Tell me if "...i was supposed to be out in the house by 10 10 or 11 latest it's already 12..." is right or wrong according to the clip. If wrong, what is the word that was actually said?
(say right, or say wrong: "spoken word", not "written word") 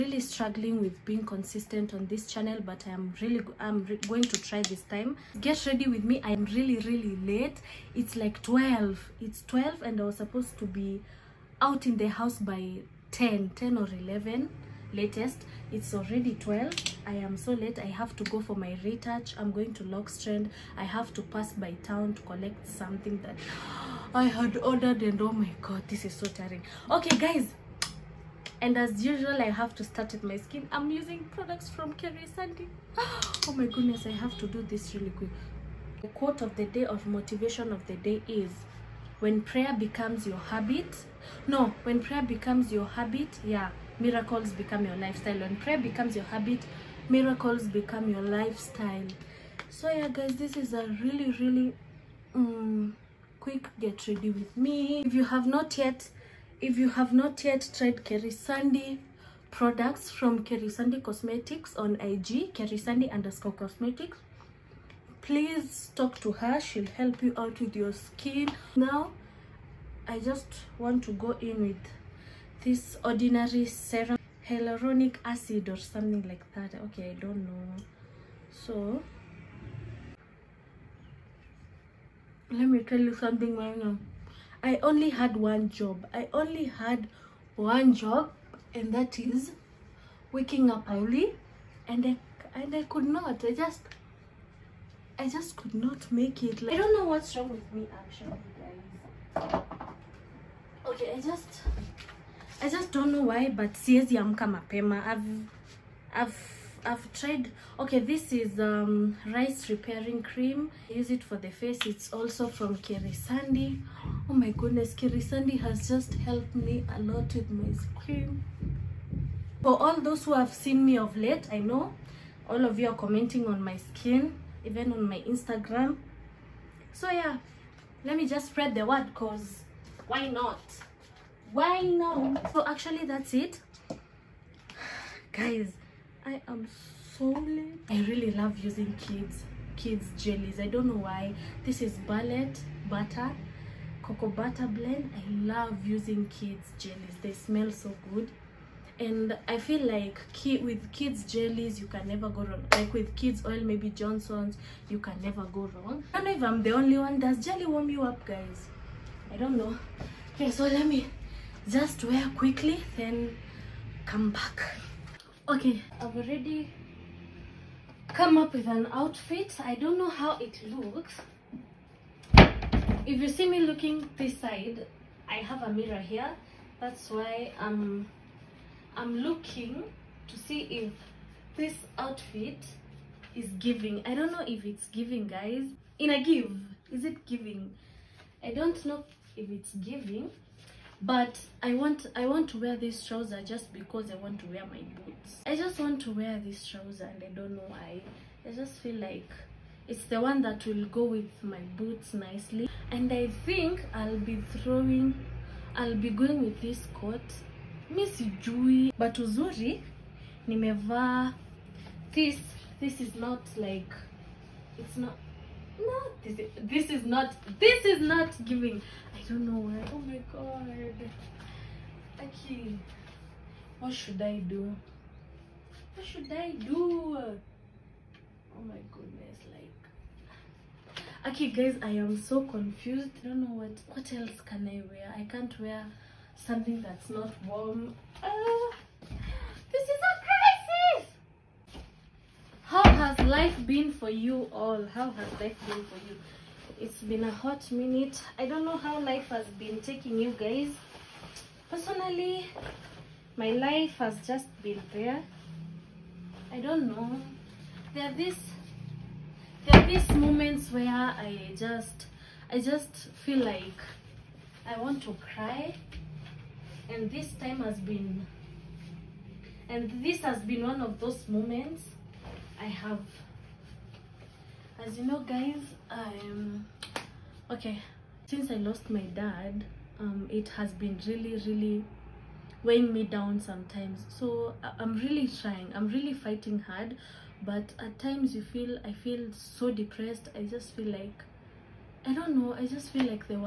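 right.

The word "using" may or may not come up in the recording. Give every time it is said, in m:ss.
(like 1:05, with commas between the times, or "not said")
0:30, 2:18, 2:25.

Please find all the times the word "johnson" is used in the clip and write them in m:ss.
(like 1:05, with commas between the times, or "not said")
2:33.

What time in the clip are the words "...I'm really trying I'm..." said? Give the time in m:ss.
4:44.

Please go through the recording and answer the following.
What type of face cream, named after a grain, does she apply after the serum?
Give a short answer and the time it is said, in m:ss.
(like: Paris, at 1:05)
rice repairing cream, at 1:49.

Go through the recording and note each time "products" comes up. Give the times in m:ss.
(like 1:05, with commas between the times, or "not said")
0:31, 0:59.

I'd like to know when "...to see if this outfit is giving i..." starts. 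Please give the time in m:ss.
3:00.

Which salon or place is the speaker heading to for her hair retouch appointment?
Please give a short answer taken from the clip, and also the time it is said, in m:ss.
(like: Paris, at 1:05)
Locs Trend, at 0:19.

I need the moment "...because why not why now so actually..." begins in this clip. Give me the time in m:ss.
2:09.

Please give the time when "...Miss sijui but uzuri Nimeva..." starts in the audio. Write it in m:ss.
3:27.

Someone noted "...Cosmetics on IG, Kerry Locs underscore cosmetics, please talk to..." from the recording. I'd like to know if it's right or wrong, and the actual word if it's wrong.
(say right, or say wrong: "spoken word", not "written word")
wrong: "Sandy", not "Locs".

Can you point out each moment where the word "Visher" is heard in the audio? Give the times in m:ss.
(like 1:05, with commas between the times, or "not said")
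not said.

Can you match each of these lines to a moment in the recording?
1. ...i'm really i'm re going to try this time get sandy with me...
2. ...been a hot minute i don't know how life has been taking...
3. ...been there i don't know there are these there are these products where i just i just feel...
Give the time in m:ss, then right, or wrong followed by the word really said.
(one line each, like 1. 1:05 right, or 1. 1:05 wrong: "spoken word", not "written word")
1. 0:02 wrong: "ready", not "sandy"
2. 4:07 right
3. 4:14 wrong: "moments", not "products".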